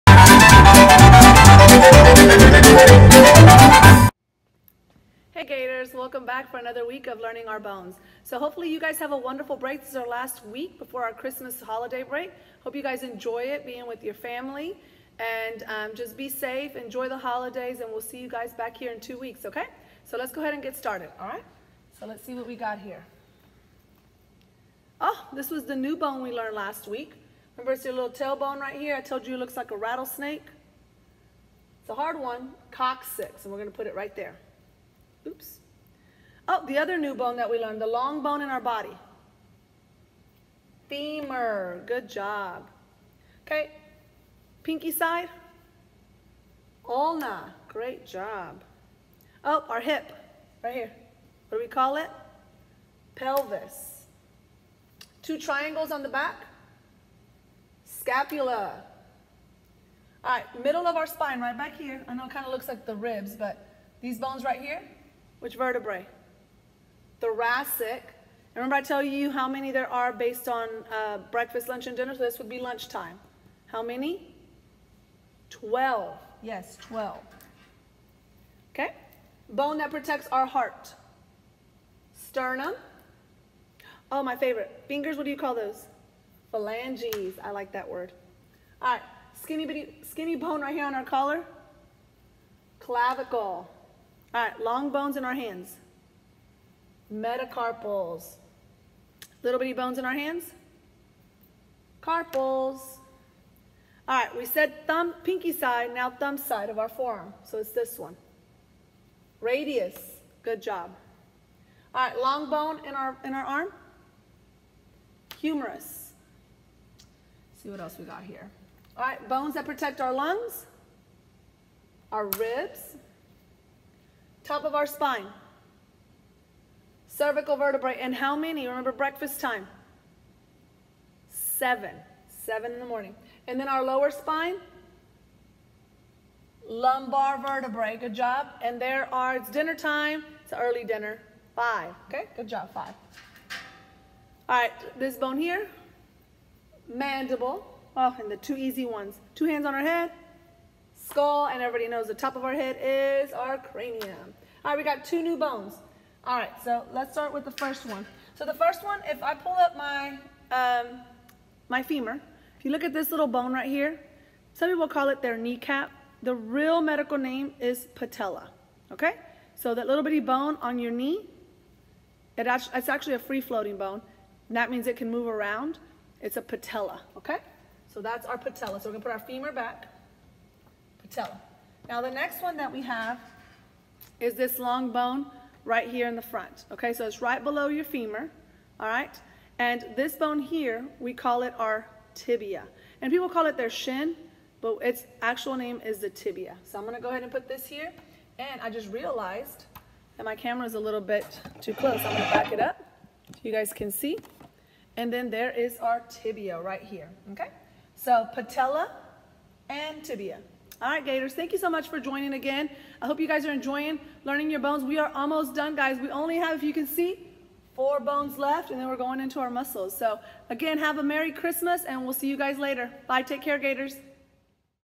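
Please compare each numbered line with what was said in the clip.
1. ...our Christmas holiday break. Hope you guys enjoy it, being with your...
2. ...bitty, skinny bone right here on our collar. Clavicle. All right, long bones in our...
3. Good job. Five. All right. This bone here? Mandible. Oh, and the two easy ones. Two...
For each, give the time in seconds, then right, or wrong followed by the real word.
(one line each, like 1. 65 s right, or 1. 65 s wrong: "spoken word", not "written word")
1. 11 s right
2. 89 s right
3. 142 s right.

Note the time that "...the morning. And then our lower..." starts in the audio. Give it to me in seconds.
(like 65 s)
132 s.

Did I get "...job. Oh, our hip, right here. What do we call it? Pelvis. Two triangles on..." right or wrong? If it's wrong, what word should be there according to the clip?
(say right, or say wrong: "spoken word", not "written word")
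right.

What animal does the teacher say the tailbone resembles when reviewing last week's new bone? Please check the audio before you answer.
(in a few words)
rattlesnake.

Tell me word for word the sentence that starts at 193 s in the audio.
And people call it their shin, but its actual name is the tibia.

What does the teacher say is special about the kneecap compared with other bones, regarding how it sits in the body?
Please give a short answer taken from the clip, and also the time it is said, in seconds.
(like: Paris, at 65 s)
free-floating, at 173 s.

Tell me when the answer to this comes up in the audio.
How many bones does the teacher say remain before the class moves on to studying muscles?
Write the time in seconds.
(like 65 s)
217 s.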